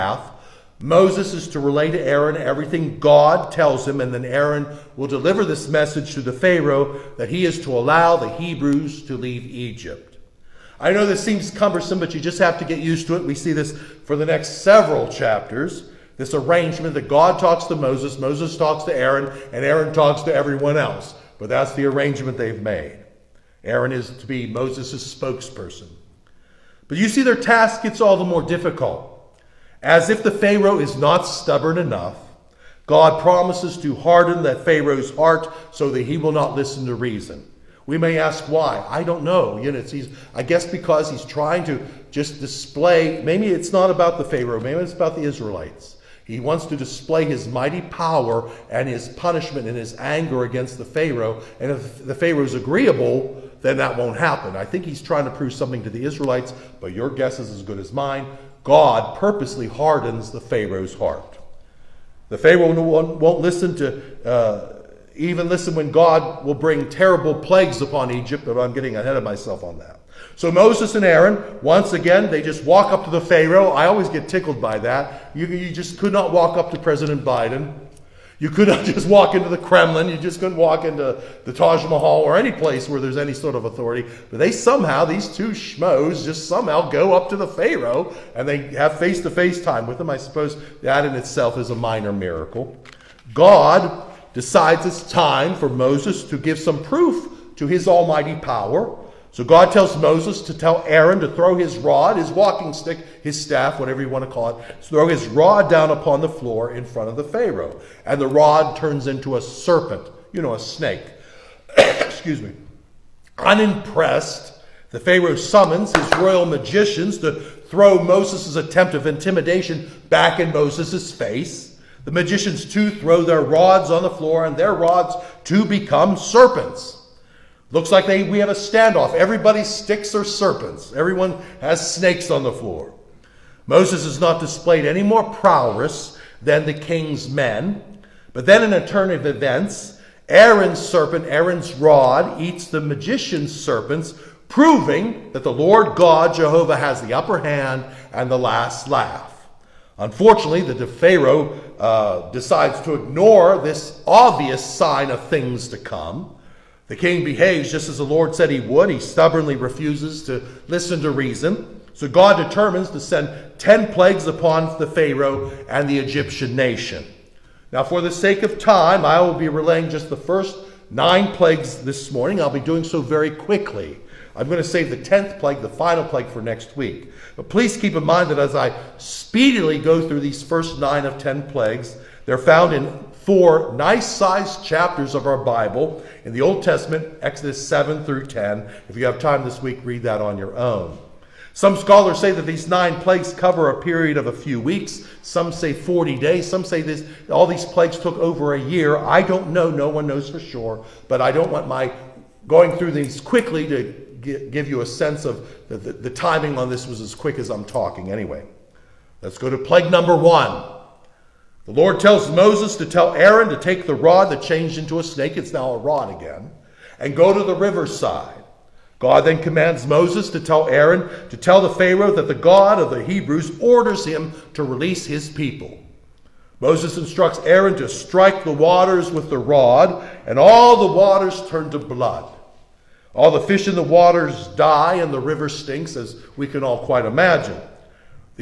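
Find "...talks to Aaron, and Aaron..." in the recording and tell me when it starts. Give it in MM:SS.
00:18.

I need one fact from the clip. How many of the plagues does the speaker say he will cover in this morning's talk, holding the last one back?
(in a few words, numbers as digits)
9.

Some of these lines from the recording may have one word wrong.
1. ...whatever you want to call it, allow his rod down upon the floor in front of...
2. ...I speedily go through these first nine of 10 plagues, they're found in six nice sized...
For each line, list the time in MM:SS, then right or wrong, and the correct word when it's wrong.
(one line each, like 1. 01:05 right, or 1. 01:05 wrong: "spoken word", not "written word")
1. 01:43 wrong: "throw", not "allow"
2. 02:58 wrong: "four", not "six".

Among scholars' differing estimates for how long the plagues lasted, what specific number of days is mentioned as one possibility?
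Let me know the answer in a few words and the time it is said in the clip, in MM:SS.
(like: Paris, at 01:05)
40 days, at 03:15.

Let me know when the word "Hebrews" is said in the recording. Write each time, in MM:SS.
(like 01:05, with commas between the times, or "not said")
00:08, 03:43.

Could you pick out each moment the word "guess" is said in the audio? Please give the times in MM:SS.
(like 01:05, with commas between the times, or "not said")
00:40, 00:57.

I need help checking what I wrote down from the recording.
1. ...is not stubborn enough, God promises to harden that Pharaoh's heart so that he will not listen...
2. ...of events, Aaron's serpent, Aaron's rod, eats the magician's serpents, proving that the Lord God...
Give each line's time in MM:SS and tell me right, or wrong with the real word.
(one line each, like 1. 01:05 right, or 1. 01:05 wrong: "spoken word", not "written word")
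1. 00:30 right
2. 02:19 right.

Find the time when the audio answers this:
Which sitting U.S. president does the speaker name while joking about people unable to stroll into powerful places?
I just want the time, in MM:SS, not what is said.
01:16.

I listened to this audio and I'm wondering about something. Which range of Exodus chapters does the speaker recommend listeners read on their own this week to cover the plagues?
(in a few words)
Exodus 7 through 10.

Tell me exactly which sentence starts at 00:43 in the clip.
Maybe it's not about the Pharaoh.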